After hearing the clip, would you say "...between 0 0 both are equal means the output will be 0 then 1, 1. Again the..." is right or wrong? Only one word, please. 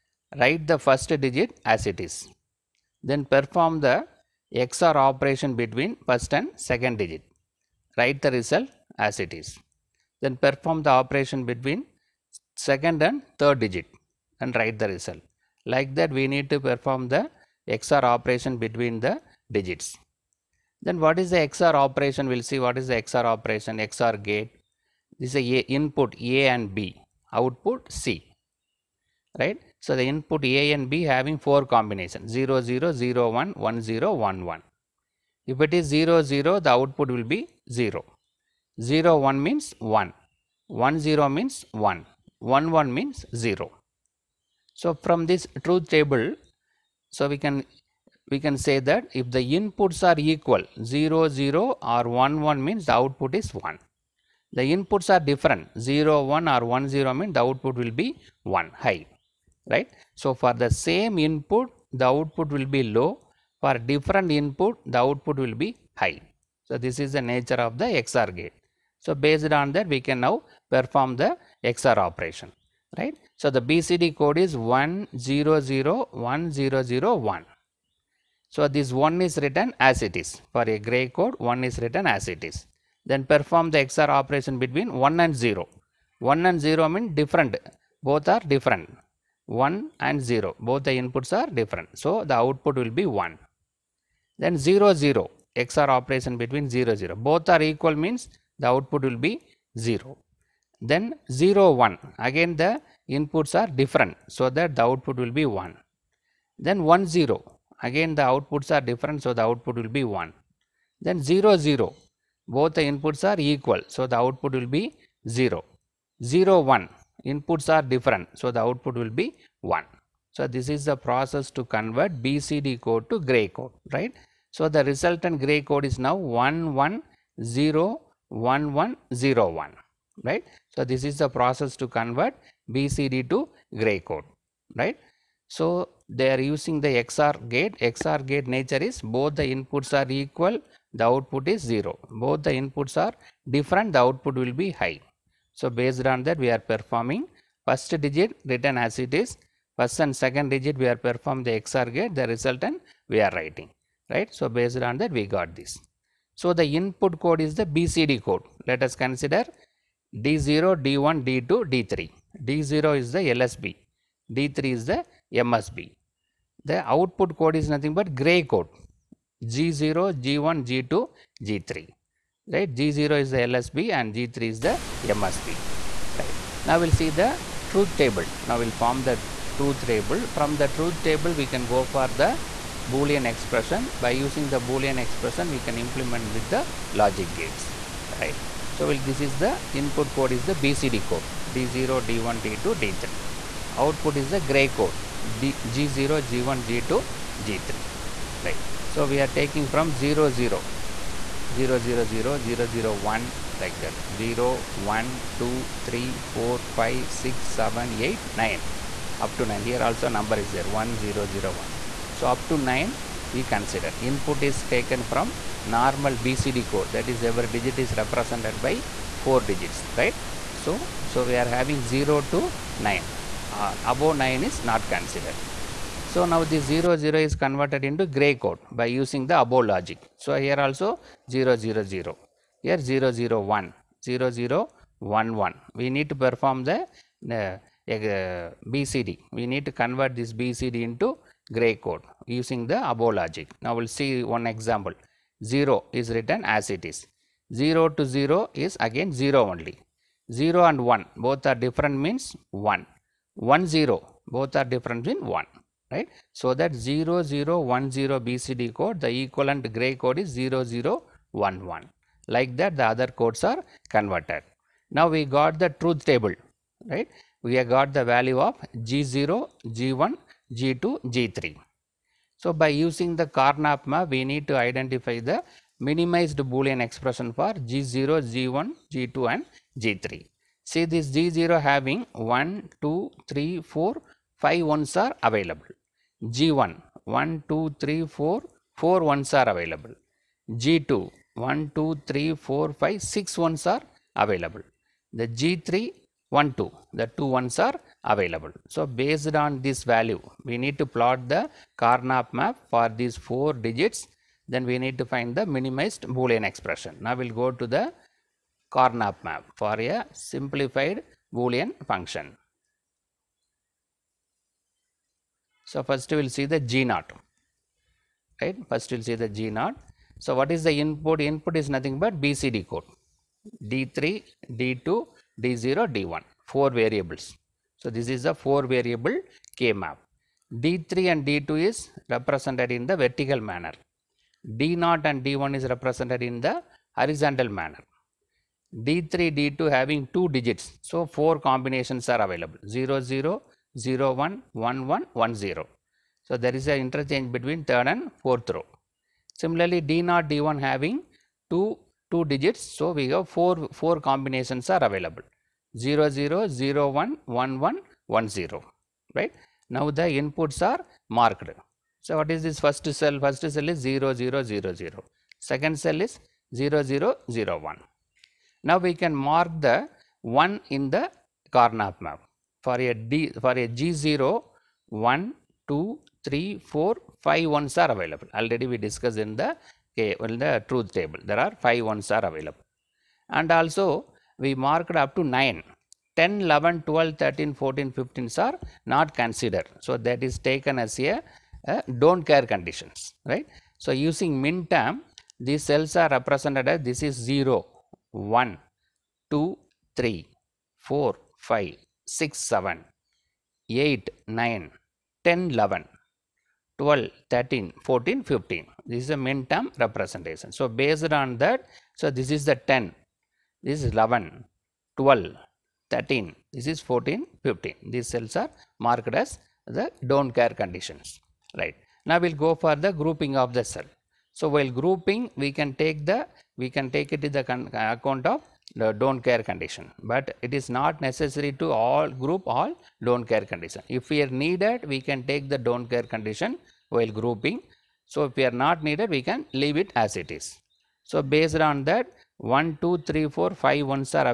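wrong.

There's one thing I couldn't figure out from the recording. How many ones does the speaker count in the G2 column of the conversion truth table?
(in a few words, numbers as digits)
6.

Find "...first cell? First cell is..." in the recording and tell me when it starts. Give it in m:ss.
6:02.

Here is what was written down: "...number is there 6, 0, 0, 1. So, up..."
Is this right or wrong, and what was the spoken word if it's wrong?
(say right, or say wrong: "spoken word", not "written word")
wrong: "1", not "6".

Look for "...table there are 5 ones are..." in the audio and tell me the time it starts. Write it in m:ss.
6:20.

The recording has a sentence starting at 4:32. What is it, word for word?
So, by using the Karnaugh map, we need to identify the minimized Boolean expression for G0, G1, G2 and G3.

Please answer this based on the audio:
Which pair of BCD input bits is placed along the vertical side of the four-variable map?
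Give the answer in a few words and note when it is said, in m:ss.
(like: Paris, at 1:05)
D3 and D2, at 5:30.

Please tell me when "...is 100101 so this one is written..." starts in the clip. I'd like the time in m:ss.
1:14.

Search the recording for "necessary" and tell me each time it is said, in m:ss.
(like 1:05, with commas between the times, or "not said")
7:11.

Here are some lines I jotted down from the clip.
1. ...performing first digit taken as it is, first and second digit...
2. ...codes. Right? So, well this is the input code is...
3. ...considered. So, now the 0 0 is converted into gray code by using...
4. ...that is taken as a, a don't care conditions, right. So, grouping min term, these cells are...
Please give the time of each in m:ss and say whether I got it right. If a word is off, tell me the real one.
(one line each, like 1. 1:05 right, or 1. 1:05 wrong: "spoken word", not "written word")
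1. 2:26 wrong: "written", not "taken"
2. 3:07 wrong: "gates", not "codes"
3. 3:44 right
4. 6:30 wrong: "using", not "grouping".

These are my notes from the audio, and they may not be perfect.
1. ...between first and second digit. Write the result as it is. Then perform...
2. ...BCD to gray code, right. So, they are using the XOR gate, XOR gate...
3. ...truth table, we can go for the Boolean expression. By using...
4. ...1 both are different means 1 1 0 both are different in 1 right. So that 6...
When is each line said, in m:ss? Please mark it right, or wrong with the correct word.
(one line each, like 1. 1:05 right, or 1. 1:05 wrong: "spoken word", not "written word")
1. 0:05 right
2. 2:12 right
3. 3:00 right
4. 4:10 wrong: "0", not "6".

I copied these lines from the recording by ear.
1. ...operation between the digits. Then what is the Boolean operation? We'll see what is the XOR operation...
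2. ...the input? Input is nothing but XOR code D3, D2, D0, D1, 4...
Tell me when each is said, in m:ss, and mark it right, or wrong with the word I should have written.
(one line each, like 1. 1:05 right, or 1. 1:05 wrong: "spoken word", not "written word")
1. 0:18 wrong: "XOR", not "Boolean"
2. 5:20 wrong: "BCD", not "XOR".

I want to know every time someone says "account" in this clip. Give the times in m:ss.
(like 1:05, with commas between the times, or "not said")
7:07.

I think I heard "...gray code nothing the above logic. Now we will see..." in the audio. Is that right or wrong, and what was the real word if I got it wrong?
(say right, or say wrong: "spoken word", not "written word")
wrong: "using", not "nothing".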